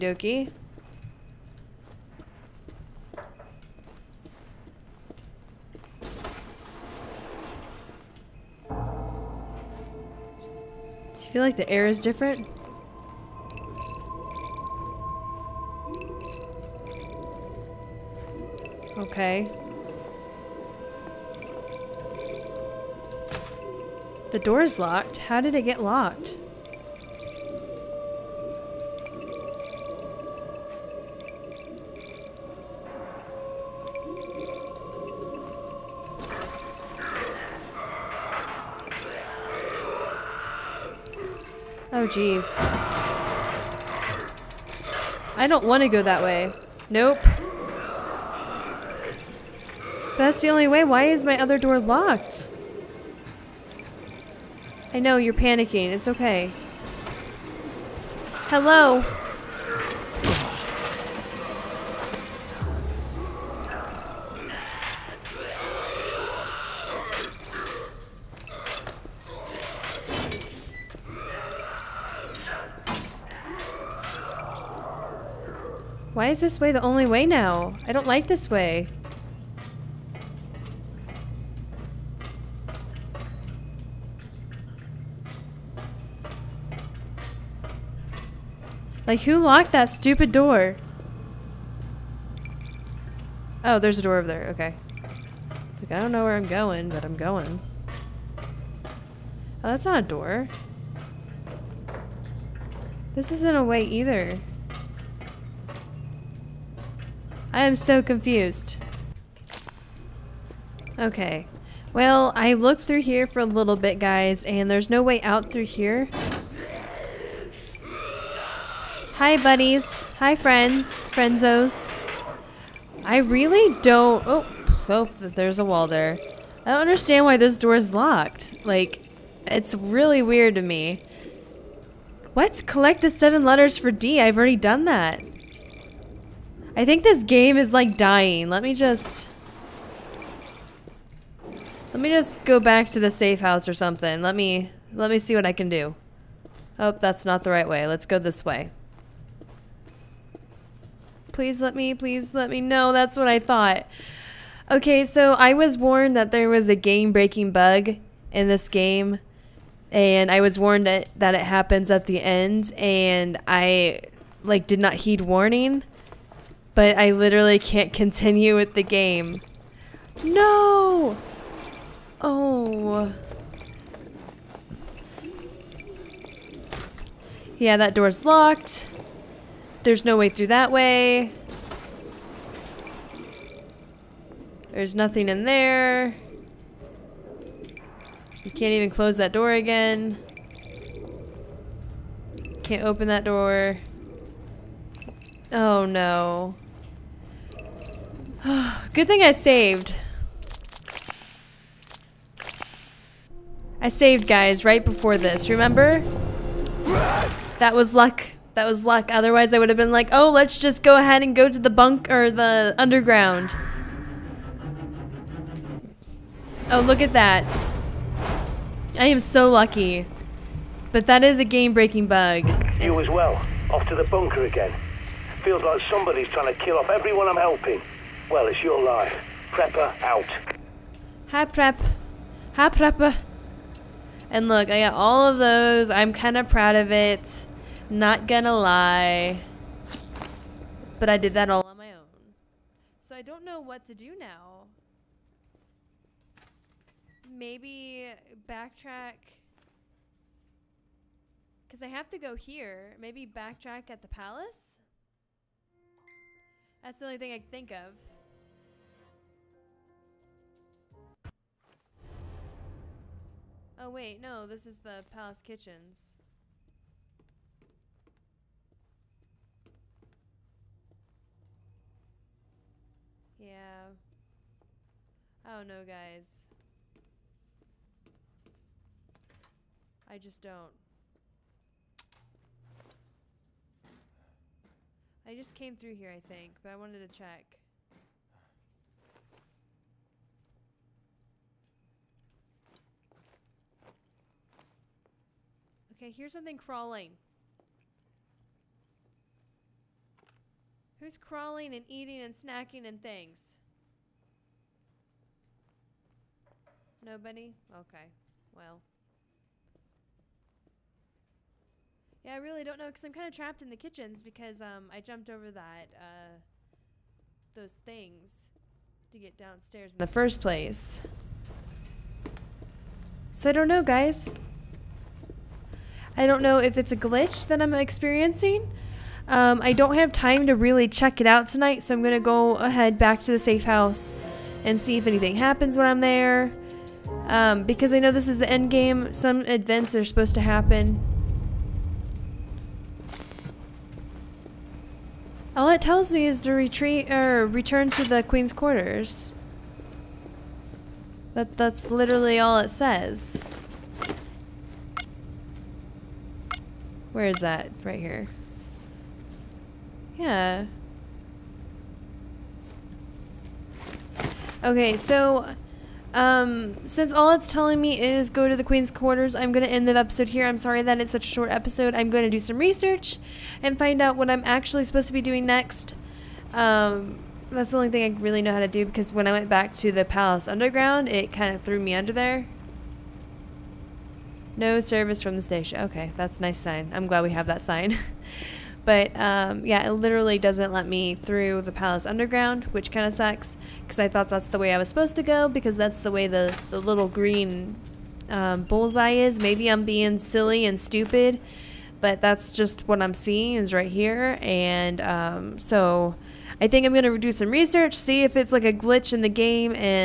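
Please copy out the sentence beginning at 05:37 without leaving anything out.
Um, because I know this is the end game.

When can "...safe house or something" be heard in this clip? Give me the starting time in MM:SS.
02:23.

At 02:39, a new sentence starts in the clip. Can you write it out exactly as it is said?
And I was warned that, that it happens at the end.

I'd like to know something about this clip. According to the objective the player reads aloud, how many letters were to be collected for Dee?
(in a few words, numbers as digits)
7.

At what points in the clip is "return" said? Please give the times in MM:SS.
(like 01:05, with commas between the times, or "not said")
05:47.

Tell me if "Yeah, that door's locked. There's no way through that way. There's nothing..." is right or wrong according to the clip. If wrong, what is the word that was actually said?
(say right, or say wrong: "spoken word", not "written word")
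right.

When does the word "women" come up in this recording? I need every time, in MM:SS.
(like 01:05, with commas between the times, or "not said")
not said.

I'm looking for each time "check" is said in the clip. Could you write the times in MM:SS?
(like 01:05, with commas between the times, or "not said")
04:47, 05:30.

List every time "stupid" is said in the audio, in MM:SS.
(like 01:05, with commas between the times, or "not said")
01:29, 06:40.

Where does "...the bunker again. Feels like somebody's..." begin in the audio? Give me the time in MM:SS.
03:43.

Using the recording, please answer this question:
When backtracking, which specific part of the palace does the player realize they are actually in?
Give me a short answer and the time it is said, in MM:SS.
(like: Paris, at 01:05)
palace kitchens, at 04:25.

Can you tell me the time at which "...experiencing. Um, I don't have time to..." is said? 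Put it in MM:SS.
05:27.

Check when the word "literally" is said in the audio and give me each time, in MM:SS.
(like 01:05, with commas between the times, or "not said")
02:47, 05:51, 06:29.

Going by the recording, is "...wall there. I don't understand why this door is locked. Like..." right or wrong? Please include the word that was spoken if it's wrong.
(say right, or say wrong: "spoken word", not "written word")
right.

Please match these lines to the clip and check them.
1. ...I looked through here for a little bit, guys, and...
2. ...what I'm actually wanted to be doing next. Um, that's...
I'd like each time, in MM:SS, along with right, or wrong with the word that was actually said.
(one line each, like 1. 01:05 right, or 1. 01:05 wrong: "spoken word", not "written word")
1. 01:52 right
2. 06:14 wrong: "supposed", not "wanted".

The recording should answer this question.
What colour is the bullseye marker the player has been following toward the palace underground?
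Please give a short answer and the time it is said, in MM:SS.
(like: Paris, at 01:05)
green, at 06:37.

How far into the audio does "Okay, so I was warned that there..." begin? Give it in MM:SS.
02:34.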